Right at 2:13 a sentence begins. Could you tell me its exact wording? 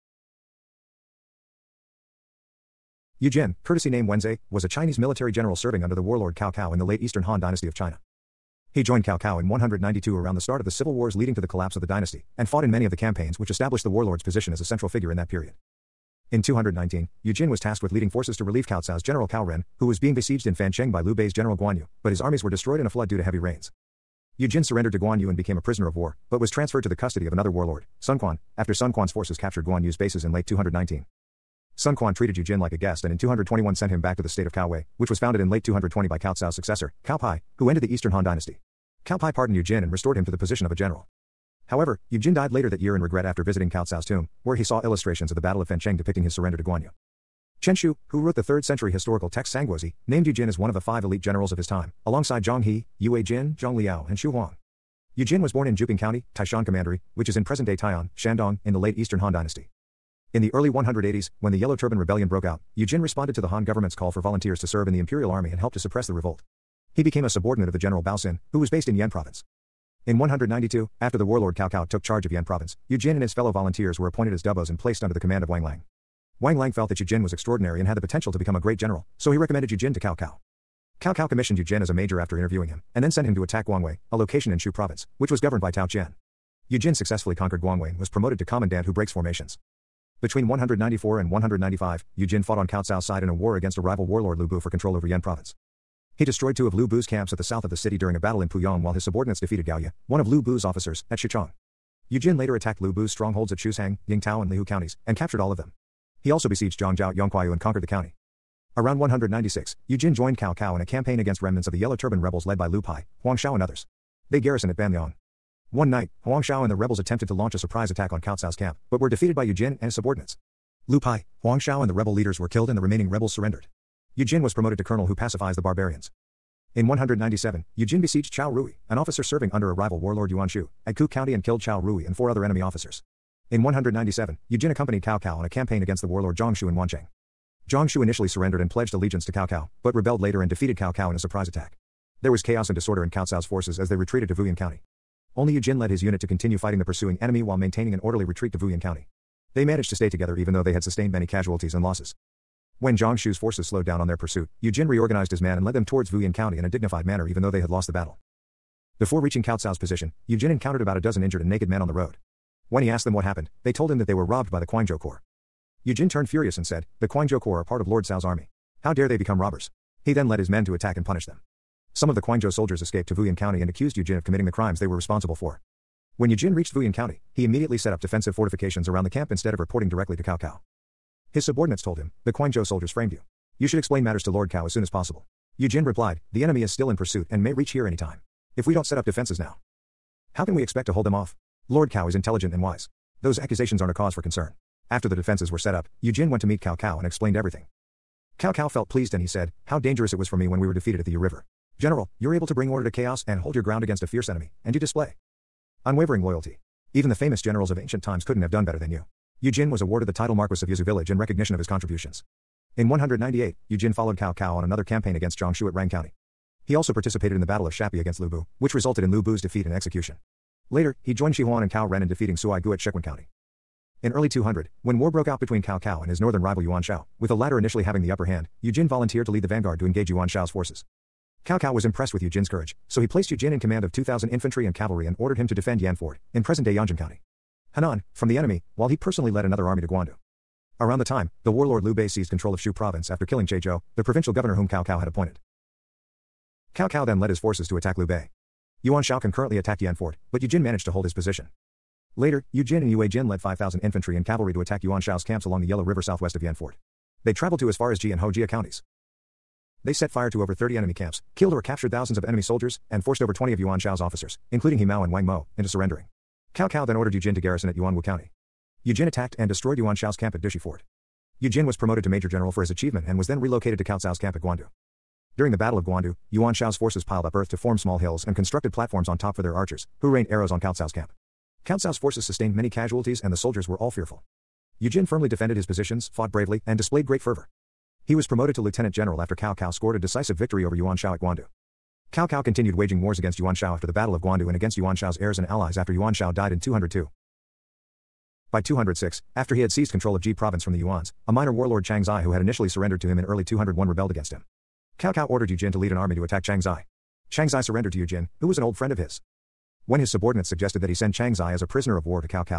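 In 197, Yujin accompanied Cao Cao on a campaign against the warlord Zhang Xiu in Wancheng.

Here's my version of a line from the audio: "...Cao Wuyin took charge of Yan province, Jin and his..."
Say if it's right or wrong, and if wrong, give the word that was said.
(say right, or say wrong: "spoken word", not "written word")
wrong: "Cao", not "Wuyin".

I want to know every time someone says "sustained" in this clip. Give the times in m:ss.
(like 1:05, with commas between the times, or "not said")
2:30, 4:42.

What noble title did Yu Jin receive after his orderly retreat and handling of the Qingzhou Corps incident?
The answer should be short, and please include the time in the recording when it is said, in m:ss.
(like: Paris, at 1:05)
Marquis of Yuzu Village, at 3:30.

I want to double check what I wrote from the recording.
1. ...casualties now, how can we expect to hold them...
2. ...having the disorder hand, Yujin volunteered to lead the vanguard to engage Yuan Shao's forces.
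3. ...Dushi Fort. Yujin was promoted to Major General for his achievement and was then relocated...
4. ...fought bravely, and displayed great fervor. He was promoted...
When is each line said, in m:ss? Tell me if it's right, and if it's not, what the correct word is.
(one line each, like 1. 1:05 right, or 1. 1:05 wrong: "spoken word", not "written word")
1. 3:09 wrong: "defenses", not "casualties"
2. 3:47 wrong: "upper", not "disorder"
3. 4:30 right
4. 4:46 right.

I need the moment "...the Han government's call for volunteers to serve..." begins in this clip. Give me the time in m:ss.
1:03.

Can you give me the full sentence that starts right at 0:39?
Cao Pi pardoned Yu Jin and restored him to the position of a general.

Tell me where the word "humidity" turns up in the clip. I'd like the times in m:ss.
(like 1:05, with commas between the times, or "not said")
not said.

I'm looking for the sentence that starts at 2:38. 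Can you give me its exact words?
Before reaching Cao Cao's position, Yu Jin encountered about a dozen injured and naked men on the road.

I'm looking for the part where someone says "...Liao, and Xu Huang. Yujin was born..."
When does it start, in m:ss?
0:53.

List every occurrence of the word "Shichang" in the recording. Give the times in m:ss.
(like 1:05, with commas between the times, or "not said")
1:41.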